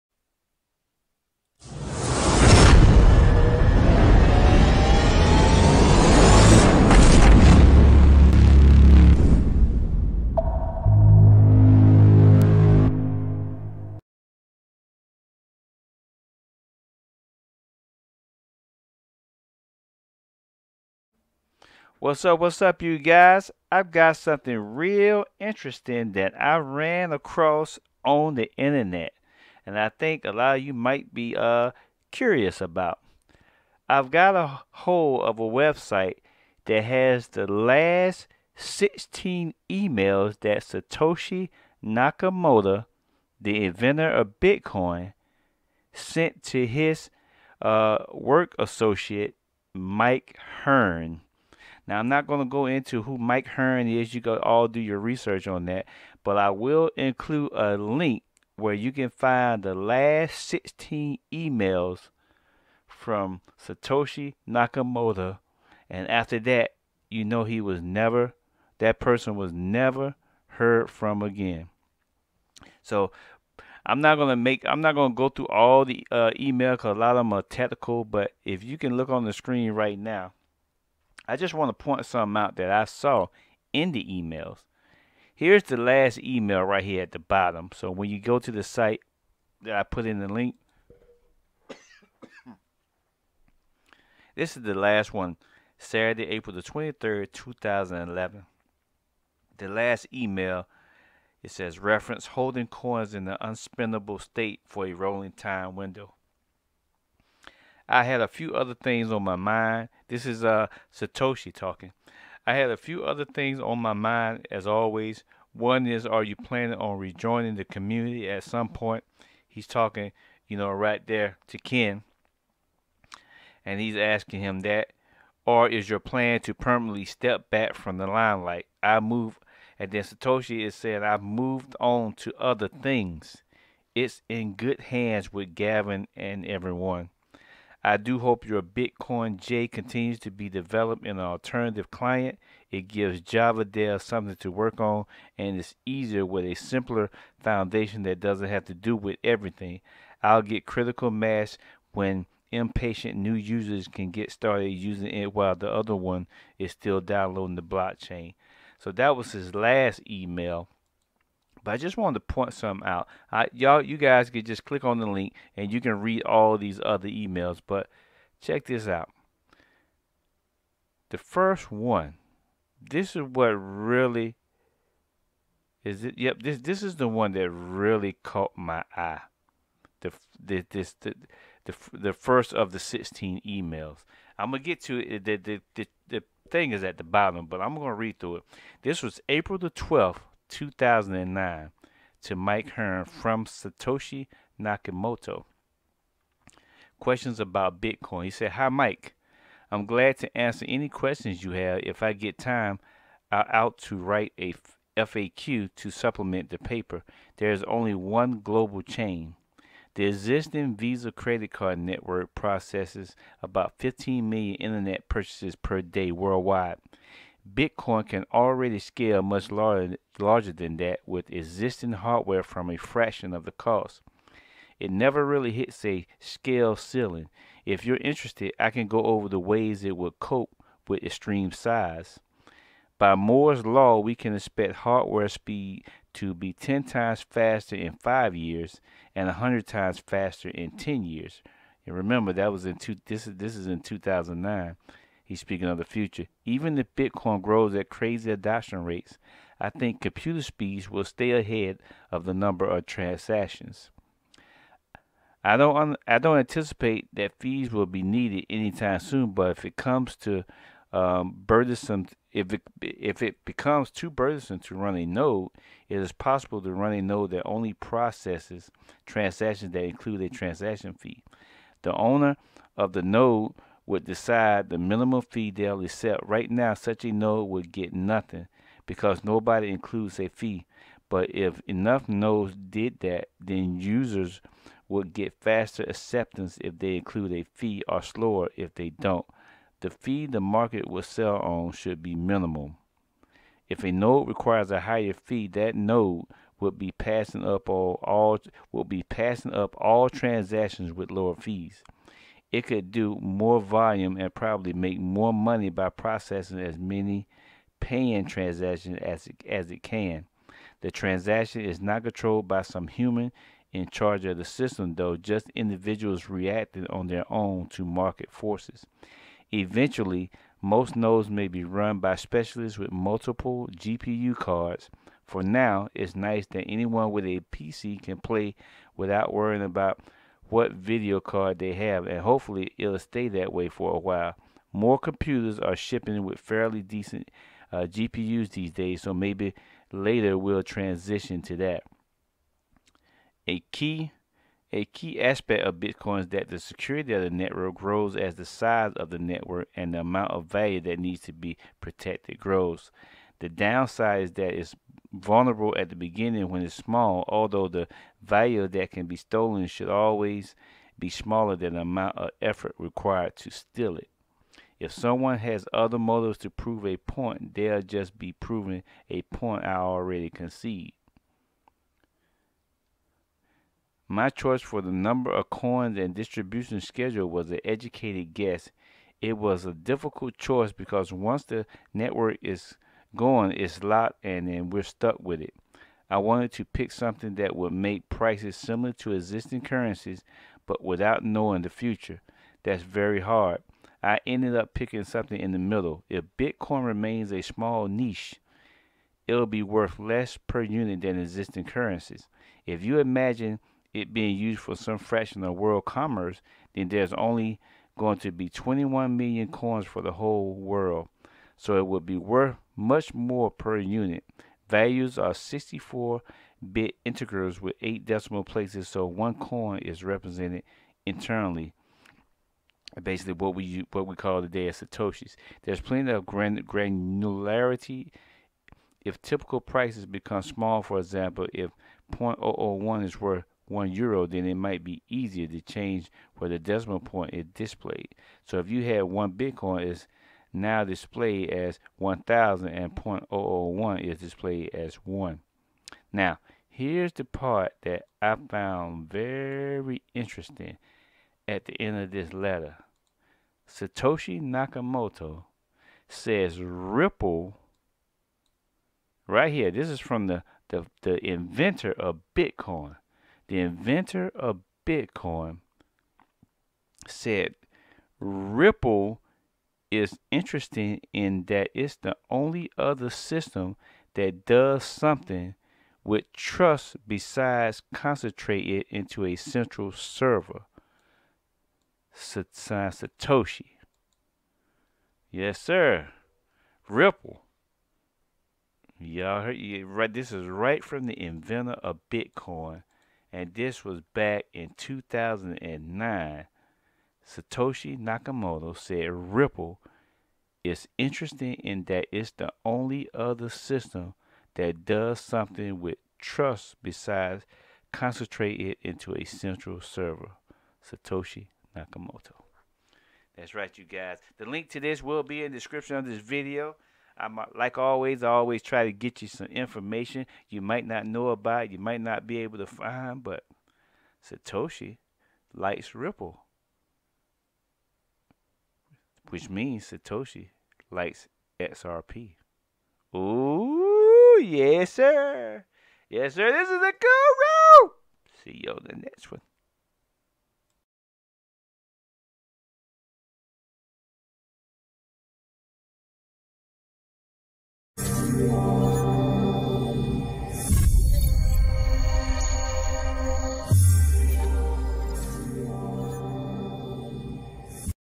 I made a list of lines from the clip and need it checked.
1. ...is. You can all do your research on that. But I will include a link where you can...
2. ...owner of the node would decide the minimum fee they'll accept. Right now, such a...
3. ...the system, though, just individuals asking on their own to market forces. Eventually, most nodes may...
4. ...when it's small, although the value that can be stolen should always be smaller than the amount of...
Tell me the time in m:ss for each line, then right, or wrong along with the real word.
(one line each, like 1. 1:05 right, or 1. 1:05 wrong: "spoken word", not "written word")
1. 0:53 right
2. 4:31 right
3. 5:14 wrong: "reacting", not "asking"
4. 5:56 right.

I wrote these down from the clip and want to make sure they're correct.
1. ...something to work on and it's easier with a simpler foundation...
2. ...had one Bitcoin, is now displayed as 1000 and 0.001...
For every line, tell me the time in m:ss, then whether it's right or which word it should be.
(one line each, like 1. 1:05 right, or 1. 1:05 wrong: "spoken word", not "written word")
1. 2:24 right
2. 7:18 right.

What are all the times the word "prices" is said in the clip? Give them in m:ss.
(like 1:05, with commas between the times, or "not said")
6:28, 7:09.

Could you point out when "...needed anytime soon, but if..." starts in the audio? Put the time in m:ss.
4:18.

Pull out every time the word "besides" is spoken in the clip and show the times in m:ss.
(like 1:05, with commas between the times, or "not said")
7:57, 8:26.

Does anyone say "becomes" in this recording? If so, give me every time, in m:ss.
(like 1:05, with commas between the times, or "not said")
4:23, 7:10.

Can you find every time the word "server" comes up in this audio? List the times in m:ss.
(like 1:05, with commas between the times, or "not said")
7:59, 8:29.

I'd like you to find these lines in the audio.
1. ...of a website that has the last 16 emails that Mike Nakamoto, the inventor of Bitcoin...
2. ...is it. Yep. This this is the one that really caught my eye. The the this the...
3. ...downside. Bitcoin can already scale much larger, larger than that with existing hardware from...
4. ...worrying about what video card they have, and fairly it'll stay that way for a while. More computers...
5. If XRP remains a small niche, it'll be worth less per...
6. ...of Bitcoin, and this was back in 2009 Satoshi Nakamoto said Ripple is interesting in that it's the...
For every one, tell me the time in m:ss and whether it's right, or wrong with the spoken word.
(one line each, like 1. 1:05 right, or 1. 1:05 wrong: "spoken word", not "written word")
1. 0:35 wrong: "Satoshi", not "Mike"
2. 2:55 right
3. 3:36 wrong: "worldwide", not "downside"
4. 5:29 wrong: "hopefully", not "fairly"
5. 6:36 wrong: "Bitcoin", not "XRP"
6. 8:11 right.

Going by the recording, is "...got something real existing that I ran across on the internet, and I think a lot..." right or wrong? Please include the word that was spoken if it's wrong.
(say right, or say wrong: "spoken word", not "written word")
wrong: "interesting", not "existing".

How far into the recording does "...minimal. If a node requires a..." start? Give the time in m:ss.
4:52.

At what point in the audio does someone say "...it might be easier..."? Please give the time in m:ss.
7:14.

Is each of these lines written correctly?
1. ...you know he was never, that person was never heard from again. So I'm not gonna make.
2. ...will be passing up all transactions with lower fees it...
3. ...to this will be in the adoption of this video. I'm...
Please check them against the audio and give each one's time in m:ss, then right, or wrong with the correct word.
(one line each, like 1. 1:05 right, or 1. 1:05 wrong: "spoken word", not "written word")
1. 1:07 right
2. 4:58 right
3. 8:34 wrong: "description", not "adoption".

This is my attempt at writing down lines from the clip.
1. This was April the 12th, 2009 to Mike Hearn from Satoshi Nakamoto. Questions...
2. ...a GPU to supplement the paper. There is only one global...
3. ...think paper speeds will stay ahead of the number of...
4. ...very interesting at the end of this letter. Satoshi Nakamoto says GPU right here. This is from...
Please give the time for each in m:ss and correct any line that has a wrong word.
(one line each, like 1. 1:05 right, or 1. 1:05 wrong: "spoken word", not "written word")
1. 3:08 right
2. 3:24 wrong: "FAQ", not "GPU"
3. 4:09 wrong: "computer", not "paper"
4. 7:29 wrong: "Ripple", not "GPU".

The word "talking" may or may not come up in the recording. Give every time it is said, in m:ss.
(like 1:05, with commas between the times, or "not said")
1:51, 1:59.